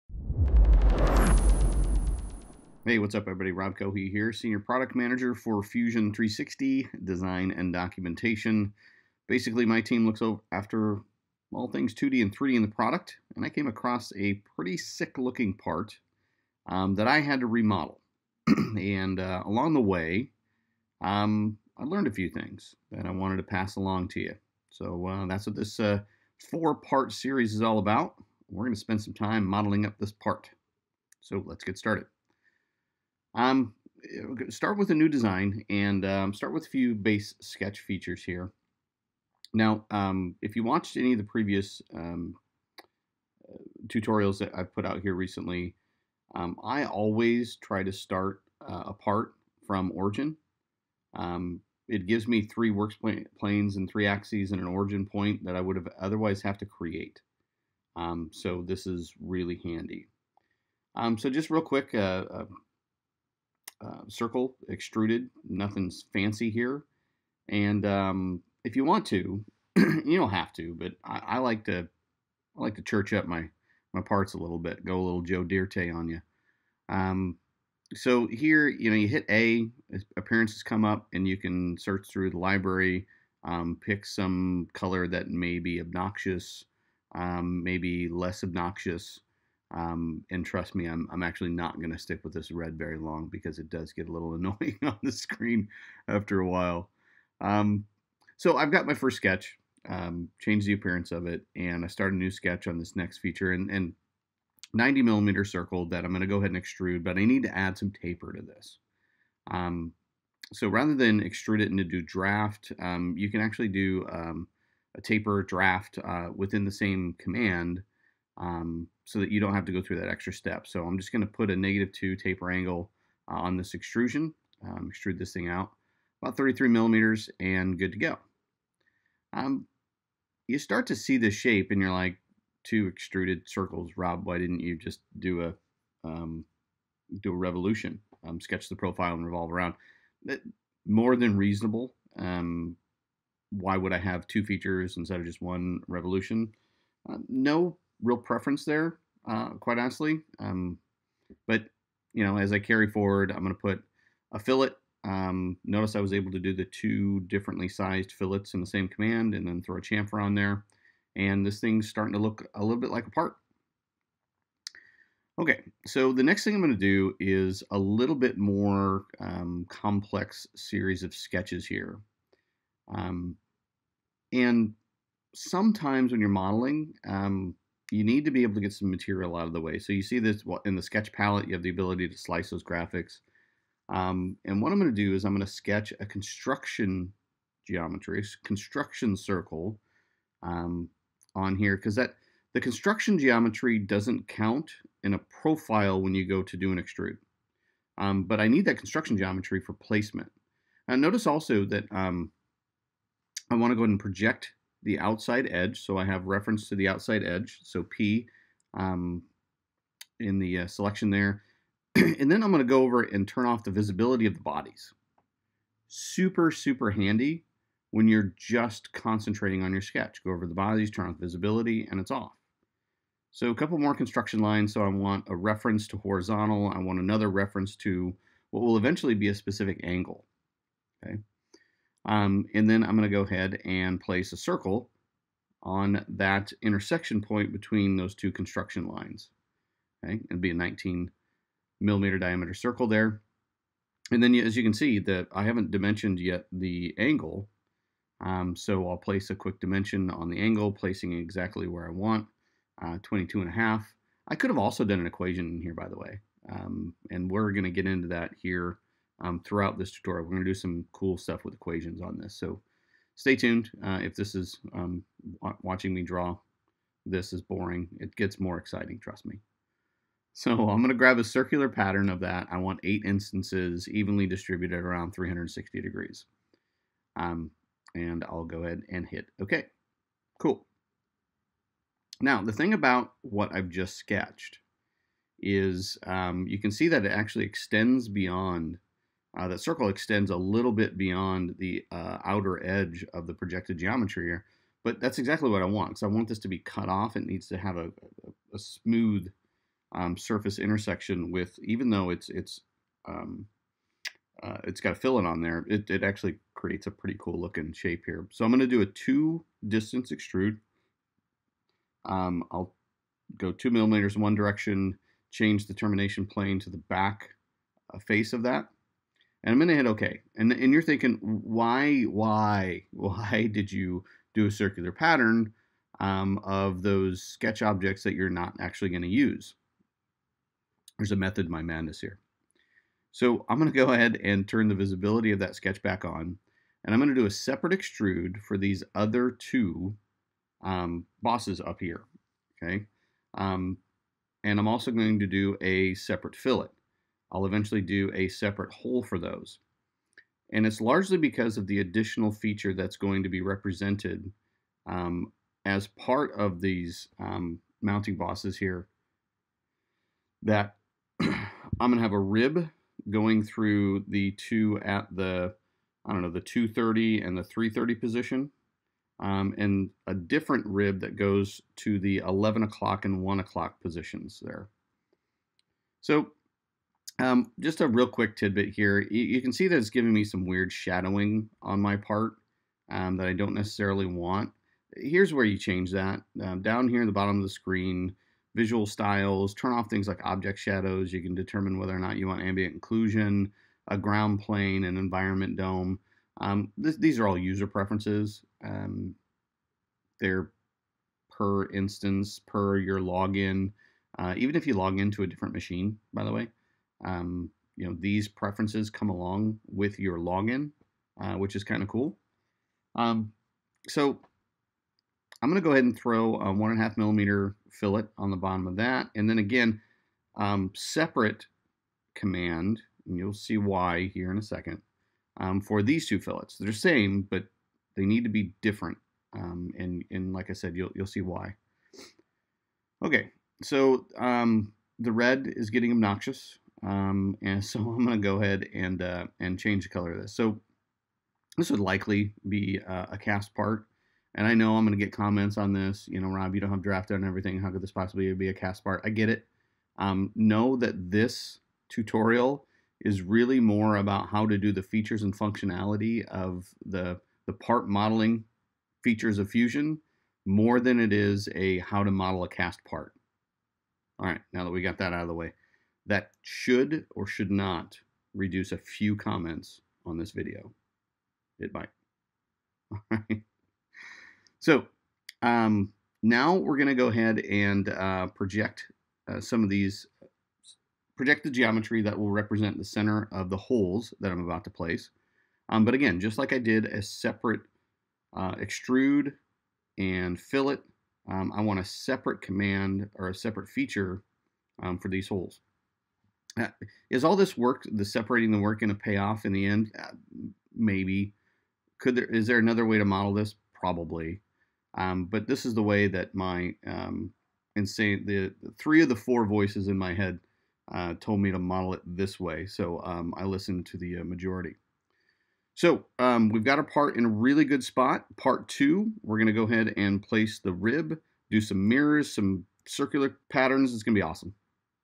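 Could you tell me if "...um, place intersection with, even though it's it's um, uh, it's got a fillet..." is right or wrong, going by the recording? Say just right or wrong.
wrong.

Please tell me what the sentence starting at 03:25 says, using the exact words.
So I have reference to the outside edge.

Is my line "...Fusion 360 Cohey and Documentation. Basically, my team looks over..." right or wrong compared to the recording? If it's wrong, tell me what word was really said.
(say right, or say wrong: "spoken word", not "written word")
wrong: "Design", not "Cohey".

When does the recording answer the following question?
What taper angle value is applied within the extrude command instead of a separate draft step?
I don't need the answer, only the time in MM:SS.
02:01.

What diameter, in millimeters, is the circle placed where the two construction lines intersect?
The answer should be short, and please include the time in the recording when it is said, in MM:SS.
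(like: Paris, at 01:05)
19, at 04:00.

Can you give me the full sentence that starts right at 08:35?
So um, we've got our part in a really good spot.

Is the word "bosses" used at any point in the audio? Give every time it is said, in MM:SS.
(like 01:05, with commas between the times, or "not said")
05:41, 05:58.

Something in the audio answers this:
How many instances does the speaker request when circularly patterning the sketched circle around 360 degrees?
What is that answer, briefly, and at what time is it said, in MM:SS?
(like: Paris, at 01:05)
8, at 04:32.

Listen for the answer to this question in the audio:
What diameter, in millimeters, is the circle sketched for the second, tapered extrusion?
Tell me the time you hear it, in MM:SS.
01:44.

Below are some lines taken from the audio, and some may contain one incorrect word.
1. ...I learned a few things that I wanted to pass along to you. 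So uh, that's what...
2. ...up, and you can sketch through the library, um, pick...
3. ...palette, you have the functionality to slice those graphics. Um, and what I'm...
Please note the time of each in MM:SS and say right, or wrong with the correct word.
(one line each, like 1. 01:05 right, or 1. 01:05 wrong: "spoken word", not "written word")
1. 00:21 right
2. 01:20 wrong: "search", not "sketch"
3. 03:01 wrong: "ability", not "functionality".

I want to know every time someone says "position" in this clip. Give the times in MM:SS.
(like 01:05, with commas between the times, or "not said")
06:07, 06:13.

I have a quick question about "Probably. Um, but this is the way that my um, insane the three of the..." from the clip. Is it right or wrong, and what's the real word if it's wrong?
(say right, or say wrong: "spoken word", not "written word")
right.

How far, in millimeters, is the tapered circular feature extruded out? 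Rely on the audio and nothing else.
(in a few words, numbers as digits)
33.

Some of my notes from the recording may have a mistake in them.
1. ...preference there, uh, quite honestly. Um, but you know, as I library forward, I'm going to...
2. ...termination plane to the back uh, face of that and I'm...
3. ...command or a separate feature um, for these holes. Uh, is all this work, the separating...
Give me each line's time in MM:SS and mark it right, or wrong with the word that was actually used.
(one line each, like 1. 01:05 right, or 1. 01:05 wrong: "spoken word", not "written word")
1. 02:28 wrong: "carry", not "library"
2. 05:15 right
3. 08:12 right.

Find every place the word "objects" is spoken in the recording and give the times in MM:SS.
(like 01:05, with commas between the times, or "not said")
05:27, 06:30.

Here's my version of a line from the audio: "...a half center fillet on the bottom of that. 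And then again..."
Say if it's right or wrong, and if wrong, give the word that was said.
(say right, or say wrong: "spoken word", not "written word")
wrong: "millimeter", not "center".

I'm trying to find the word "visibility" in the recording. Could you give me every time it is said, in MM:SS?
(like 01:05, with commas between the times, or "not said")
03:33, 03:41, 05:34.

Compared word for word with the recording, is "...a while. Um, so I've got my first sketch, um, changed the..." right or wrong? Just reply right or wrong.
right.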